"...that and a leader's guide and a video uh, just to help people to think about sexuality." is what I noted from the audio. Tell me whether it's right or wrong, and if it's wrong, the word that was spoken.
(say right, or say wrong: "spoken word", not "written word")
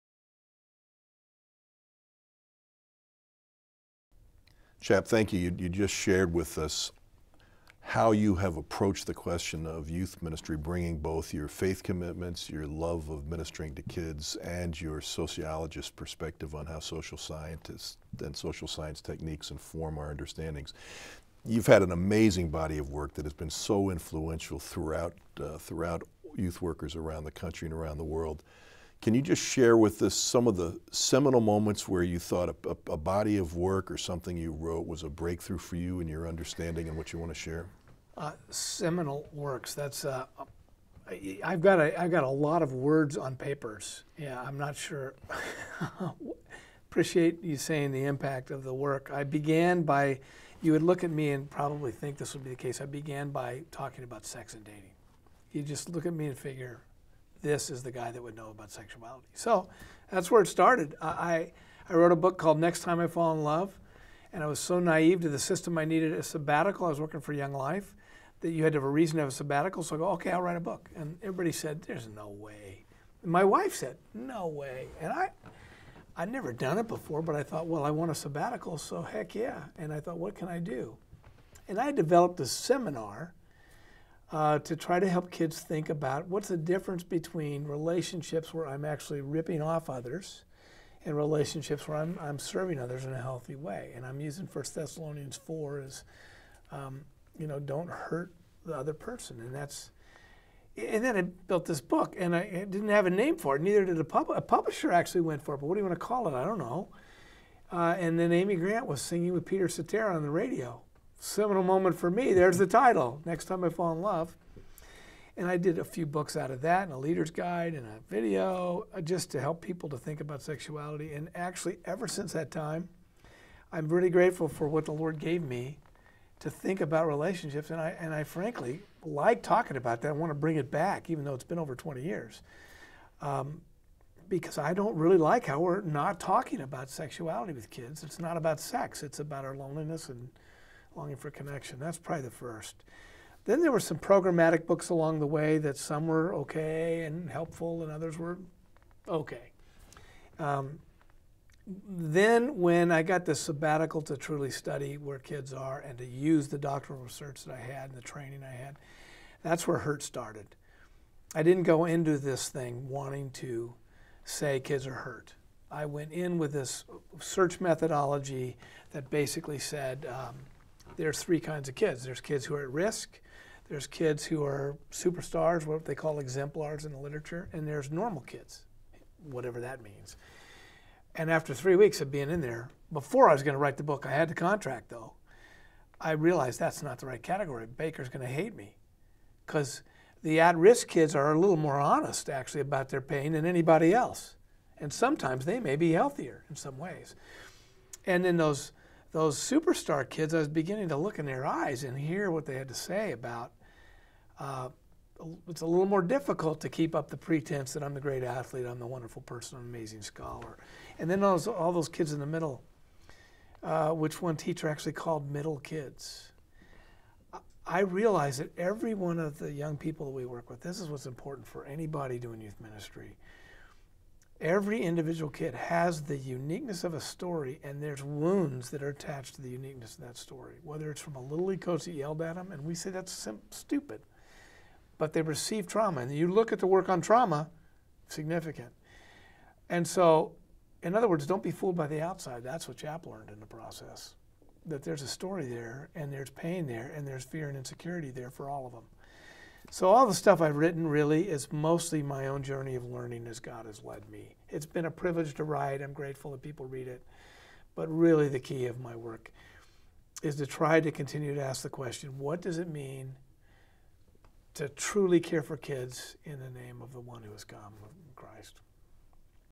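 right.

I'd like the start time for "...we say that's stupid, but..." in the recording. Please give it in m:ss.
3:52.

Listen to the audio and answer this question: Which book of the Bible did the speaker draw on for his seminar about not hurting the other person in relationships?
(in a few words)
1 Thessalonians.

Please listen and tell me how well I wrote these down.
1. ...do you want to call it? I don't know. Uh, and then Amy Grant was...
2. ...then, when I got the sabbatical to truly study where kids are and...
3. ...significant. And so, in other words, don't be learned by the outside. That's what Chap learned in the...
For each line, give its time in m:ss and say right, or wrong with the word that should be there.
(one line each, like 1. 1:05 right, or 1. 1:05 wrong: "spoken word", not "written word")
1. 1:45 right
2. 2:31 right
3. 3:58 wrong: "fooled", not "learned".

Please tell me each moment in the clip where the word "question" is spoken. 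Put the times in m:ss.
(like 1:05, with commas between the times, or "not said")
0:09, 4:21.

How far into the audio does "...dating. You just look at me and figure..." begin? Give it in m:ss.
0:54.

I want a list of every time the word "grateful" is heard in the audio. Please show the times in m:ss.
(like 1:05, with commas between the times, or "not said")
2:04, 4:15.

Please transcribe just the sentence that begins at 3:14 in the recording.
And sometimes they may be healthier in some ways.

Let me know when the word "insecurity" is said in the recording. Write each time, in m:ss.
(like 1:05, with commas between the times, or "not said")
4:07.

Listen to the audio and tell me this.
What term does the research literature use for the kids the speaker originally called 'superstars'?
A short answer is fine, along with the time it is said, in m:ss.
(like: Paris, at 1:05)
exemplars, at 2:56.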